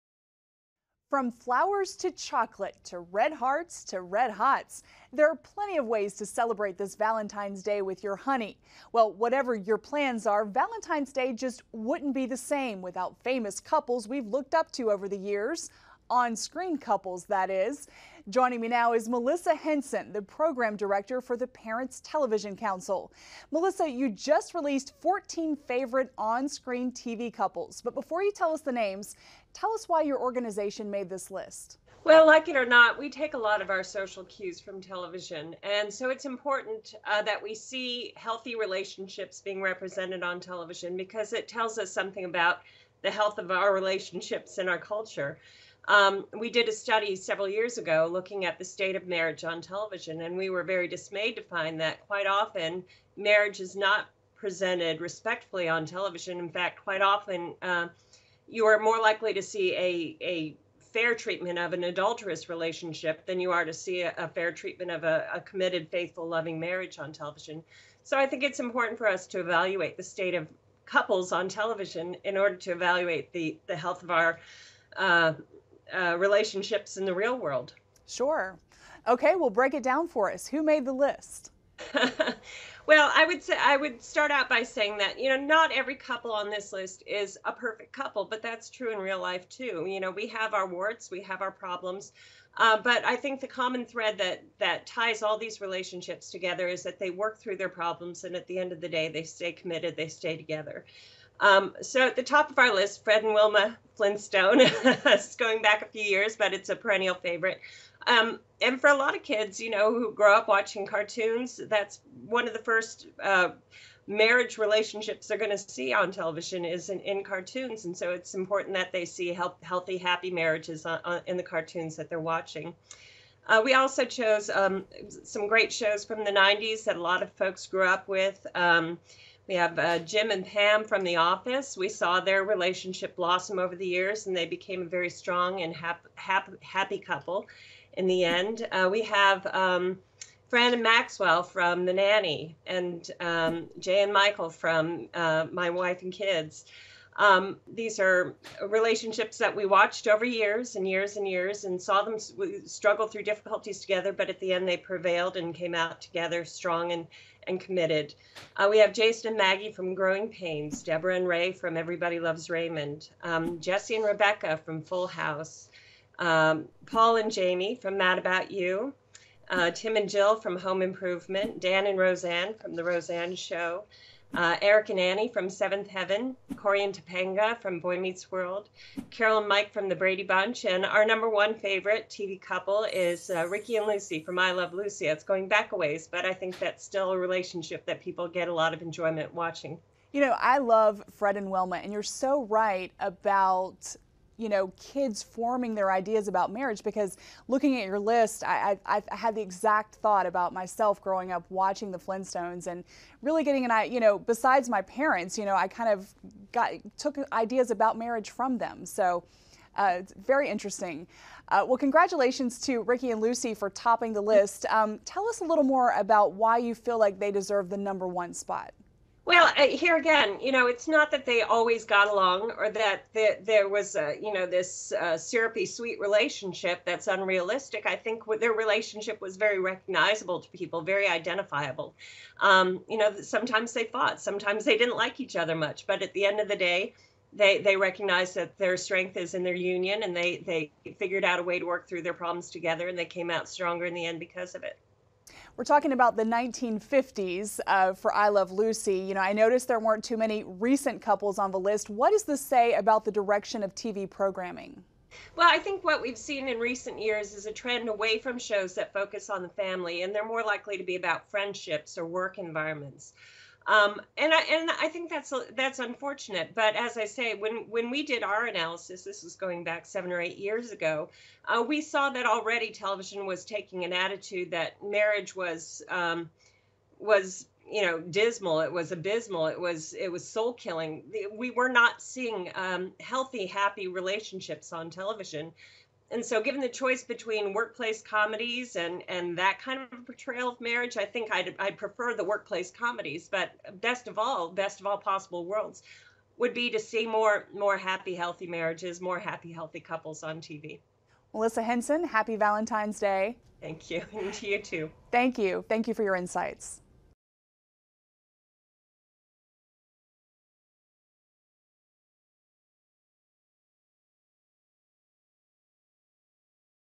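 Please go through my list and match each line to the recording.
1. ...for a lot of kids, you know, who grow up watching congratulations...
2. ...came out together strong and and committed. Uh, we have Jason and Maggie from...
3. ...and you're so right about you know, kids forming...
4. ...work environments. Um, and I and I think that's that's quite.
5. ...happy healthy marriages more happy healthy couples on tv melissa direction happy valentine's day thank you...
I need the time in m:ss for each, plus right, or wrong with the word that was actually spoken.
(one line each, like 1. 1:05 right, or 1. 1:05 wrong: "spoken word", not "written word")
1. 1:48 wrong: "cartoons", not "congratulations"
2. 2:35 right
3. 3:11 right
4. 4:22 wrong: "unfortunate", not "quite"
5. 4:57 wrong: "henson", not "direction".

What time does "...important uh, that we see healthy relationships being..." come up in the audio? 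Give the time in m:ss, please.
0:36.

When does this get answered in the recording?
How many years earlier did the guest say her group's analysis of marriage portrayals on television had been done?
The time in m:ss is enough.
4:29.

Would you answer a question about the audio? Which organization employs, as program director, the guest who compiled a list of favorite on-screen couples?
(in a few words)
Parents Television Council.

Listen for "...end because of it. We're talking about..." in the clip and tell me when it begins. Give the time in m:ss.
4:04.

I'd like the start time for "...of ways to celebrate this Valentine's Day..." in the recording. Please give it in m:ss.
0:05.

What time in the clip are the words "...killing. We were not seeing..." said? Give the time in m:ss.
4:40.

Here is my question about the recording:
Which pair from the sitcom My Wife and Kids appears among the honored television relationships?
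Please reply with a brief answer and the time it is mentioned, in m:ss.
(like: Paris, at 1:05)
Jay and Michael, at 2:23.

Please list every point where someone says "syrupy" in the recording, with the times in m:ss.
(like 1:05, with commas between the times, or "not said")
3:45.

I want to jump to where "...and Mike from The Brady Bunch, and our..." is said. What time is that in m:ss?
2:59.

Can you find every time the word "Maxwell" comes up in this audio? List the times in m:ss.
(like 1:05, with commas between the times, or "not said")
2:20.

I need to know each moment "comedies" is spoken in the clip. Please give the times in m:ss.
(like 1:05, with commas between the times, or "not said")
4:48, 4:52.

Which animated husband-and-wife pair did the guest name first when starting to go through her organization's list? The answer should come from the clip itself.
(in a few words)
Fred and Wilma Flintstone.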